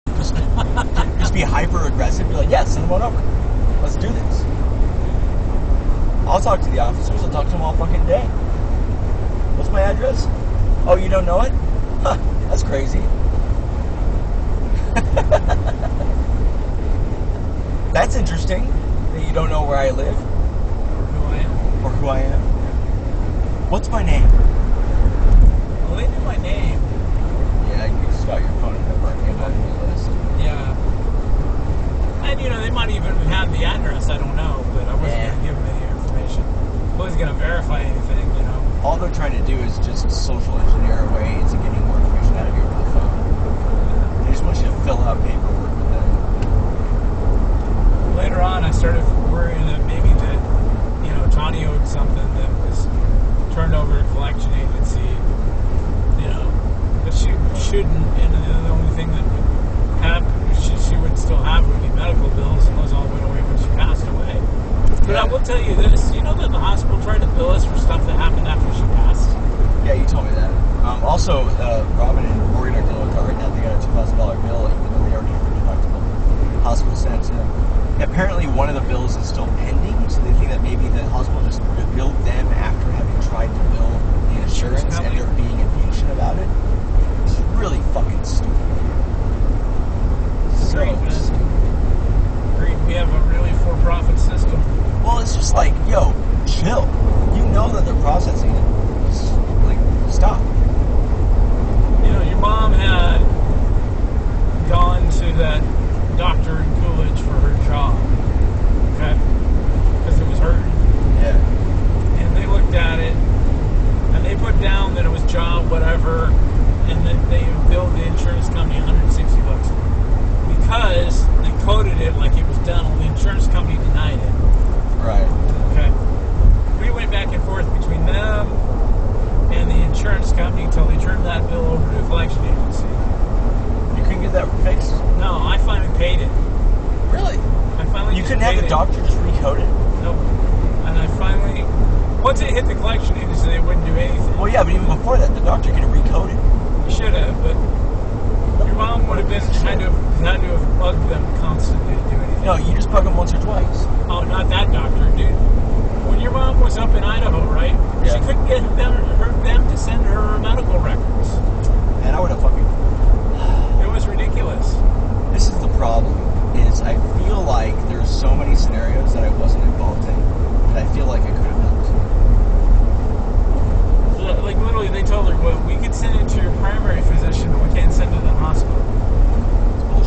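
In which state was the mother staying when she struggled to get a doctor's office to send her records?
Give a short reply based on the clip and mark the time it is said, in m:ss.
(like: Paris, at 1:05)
Idaho, at 2:37.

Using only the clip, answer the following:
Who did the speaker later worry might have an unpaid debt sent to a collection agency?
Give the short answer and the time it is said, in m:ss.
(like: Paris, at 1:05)
Johnny, at 0:51.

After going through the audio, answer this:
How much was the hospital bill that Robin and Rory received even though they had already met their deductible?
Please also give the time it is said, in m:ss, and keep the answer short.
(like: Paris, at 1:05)
$2,000, at 1:13.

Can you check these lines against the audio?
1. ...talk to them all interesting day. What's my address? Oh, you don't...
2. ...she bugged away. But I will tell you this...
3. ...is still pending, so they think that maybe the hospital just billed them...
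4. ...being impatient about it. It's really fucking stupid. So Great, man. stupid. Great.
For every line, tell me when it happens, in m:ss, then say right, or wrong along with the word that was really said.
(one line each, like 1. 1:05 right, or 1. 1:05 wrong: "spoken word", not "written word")
1. 0:07 wrong: "fucking", not "interesting"
2. 1:03 wrong: "passed", not "bugged"
3. 1:19 right
4. 1:25 right.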